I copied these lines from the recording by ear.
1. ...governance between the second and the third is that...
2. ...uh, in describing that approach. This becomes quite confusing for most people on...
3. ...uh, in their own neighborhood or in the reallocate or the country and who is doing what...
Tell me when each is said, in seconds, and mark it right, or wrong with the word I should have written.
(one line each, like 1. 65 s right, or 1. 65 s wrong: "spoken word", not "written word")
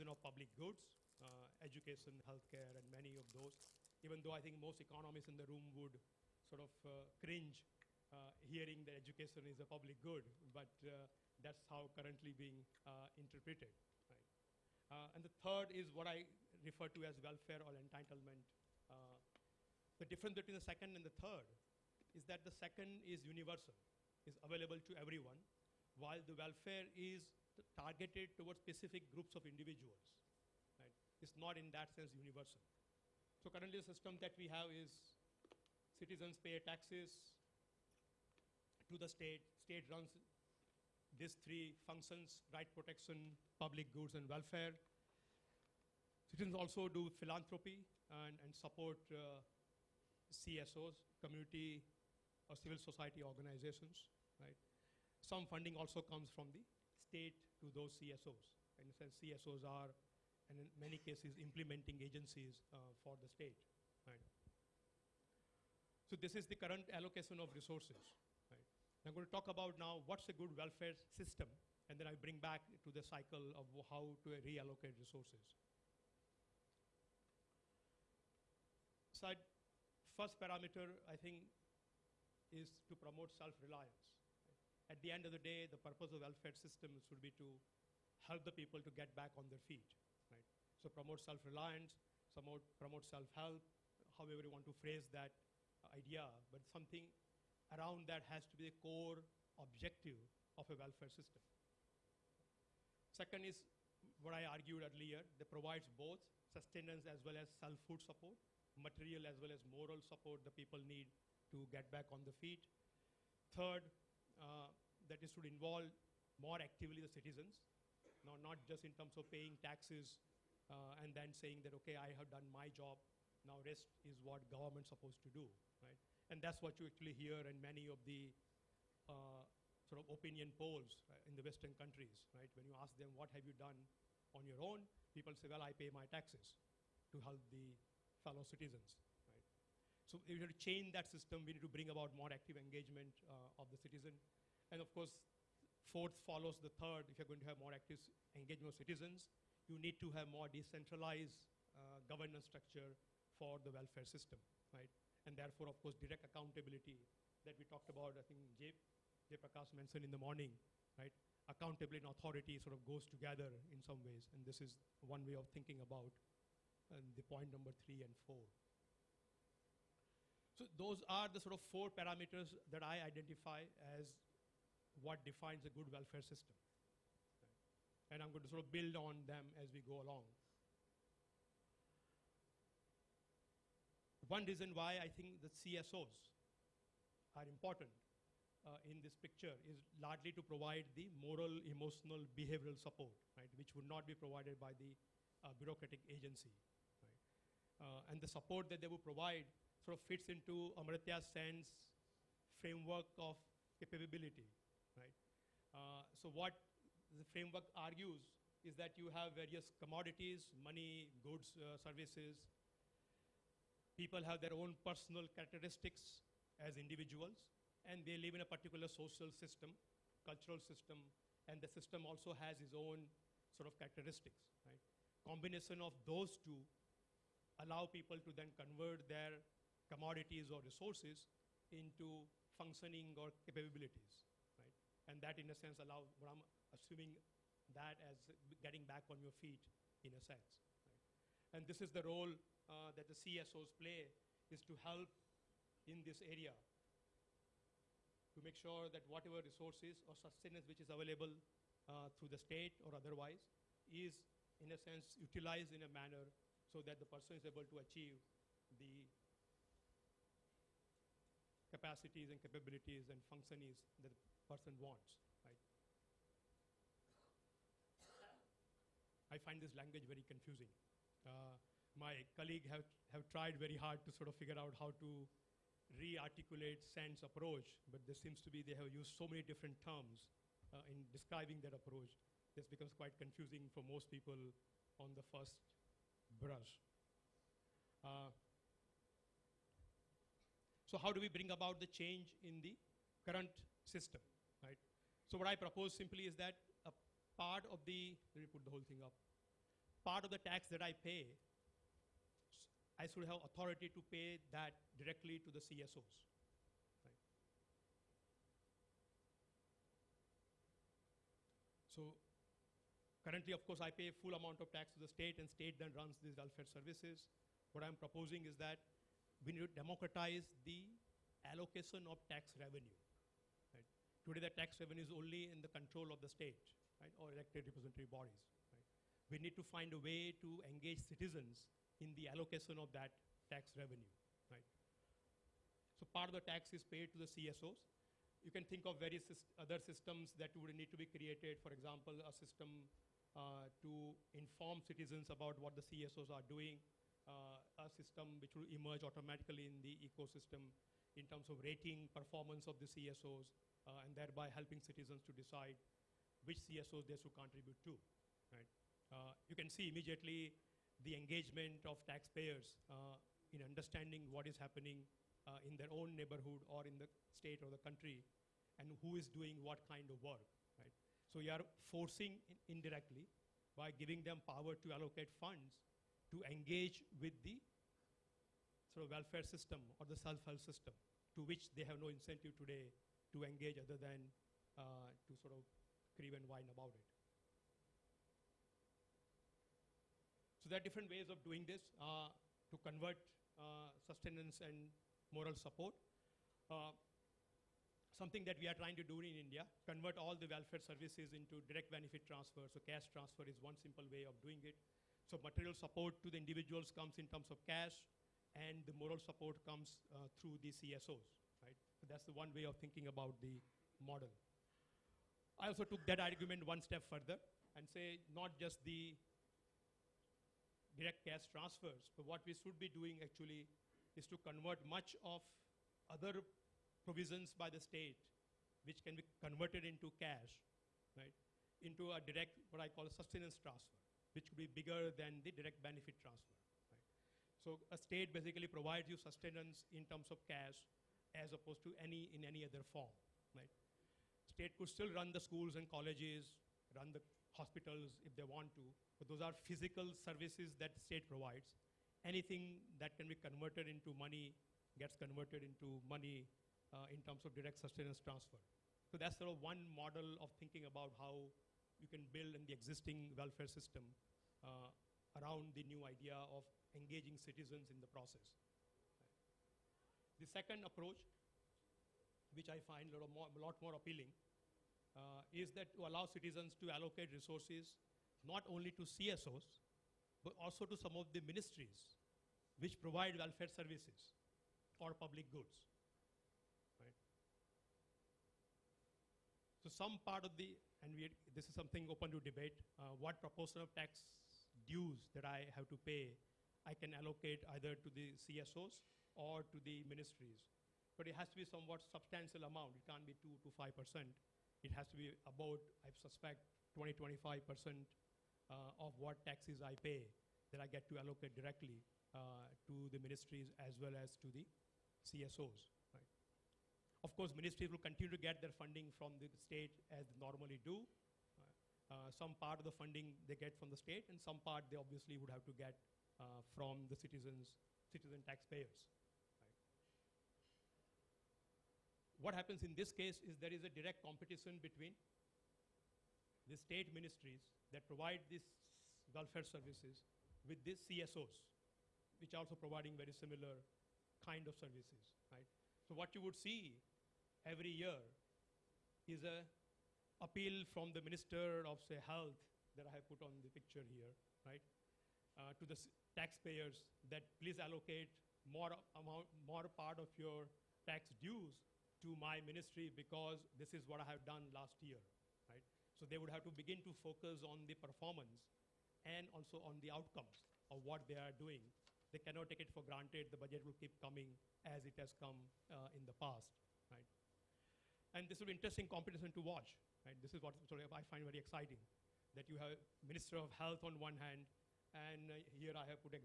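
1. 20 s wrong: "difference", not "governance"
2. 280 s right
3. 365 s wrong: "state", not "reallocate".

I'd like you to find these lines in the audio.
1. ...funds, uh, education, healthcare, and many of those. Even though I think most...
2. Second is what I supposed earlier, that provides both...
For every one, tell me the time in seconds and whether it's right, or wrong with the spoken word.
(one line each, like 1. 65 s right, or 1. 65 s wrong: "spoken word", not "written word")
1. 0 s wrong: "goods", not "funds"
2. 103 s wrong: "argued", not "supposed".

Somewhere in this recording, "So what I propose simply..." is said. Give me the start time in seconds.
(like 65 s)
295 s.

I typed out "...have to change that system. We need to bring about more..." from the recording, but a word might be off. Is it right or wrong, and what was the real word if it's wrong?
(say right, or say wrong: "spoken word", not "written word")
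right.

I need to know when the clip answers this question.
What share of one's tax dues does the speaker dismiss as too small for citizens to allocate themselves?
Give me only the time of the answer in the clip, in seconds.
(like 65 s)
503 s.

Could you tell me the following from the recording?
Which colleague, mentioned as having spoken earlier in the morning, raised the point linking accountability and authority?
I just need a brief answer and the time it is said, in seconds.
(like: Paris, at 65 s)
Jay Prakash, at 159 s.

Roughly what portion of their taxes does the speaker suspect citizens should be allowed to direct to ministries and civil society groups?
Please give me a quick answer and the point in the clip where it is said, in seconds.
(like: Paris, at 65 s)
20 to 25%, at 506 s.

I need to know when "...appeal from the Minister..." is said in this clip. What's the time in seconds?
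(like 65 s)
550 s.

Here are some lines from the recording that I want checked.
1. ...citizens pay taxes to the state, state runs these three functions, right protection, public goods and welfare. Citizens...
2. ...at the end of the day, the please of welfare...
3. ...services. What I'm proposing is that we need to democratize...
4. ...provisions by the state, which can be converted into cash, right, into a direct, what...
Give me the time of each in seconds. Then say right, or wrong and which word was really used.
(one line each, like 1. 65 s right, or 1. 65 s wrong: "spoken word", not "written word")
1. 35 s right
2. 84 s wrong: "purpose", not "please"
3. 316 s right
4. 427 s right.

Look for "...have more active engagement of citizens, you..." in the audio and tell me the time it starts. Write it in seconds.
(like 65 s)
147 s.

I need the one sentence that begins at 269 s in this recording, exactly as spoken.
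I find this language very confusing.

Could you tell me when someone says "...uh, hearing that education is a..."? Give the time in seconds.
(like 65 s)
8 s.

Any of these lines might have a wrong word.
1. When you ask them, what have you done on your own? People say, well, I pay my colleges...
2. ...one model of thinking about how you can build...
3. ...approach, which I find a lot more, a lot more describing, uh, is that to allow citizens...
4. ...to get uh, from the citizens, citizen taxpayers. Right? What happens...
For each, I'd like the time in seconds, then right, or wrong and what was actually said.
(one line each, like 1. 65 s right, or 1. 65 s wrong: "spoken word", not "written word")
1. 132 s wrong: "taxes", not "colleges"
2. 459 s right
3. 470 s wrong: "appealing", not "describing"
4. 525 s right.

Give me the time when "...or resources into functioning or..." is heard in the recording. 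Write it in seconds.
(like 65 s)
230 s.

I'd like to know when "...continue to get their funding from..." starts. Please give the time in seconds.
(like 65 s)
517 s.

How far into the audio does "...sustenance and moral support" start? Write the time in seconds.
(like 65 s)
394 s.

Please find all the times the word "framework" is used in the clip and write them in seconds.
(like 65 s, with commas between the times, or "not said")
202 s, 207 s.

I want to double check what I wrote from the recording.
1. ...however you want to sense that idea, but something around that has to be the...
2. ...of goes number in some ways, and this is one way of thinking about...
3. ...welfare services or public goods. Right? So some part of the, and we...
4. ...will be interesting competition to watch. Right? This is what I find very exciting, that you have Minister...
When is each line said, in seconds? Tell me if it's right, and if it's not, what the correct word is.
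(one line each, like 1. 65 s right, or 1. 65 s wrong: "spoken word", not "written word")
1. 94 s wrong: "phrase", not "sense"
2. 162 s wrong: "together", not "number"
3. 483 s right
4. 578 s right.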